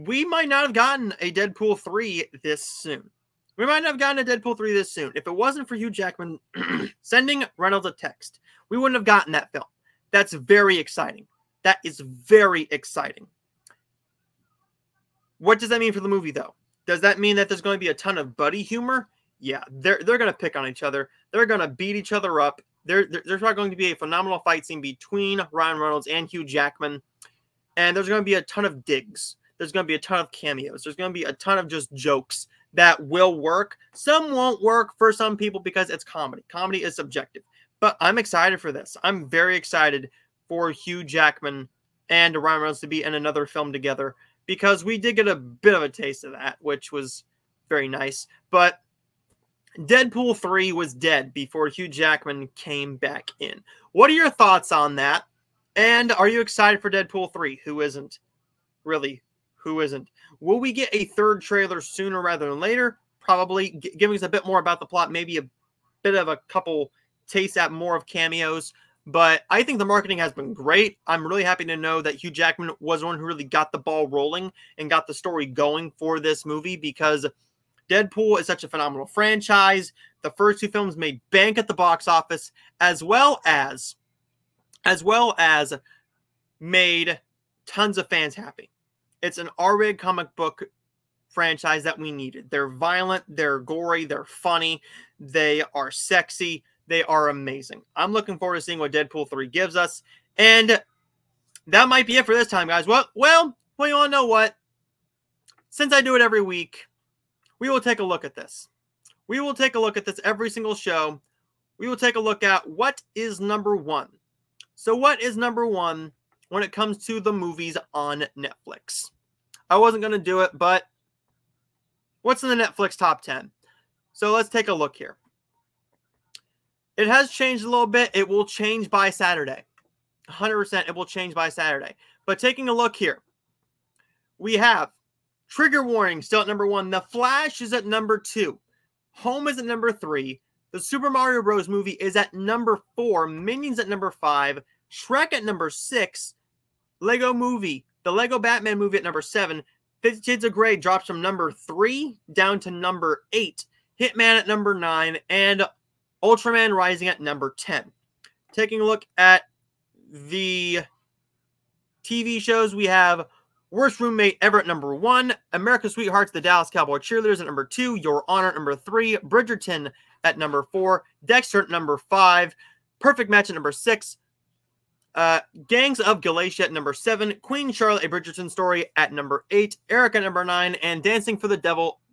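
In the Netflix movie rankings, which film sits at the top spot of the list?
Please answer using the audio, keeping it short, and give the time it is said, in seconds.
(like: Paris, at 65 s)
Trigger Warning, at 135 s.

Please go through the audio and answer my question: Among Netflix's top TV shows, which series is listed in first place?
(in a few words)
Worst Roommate Ever.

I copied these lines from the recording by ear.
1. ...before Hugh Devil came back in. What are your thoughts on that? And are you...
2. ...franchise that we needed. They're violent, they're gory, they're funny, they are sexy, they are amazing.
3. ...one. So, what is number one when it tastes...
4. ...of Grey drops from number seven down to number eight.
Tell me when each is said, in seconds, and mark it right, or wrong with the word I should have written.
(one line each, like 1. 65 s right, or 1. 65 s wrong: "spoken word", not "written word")
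1. 51 s wrong: "Jackman", not "Devil"
2. 91 s right
3. 113 s wrong: "comes", not "tastes"
4. 150 s wrong: "three", not "seven".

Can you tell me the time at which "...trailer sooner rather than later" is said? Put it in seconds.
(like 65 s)
61 s.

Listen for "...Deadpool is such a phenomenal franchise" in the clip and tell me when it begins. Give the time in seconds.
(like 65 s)
77 s.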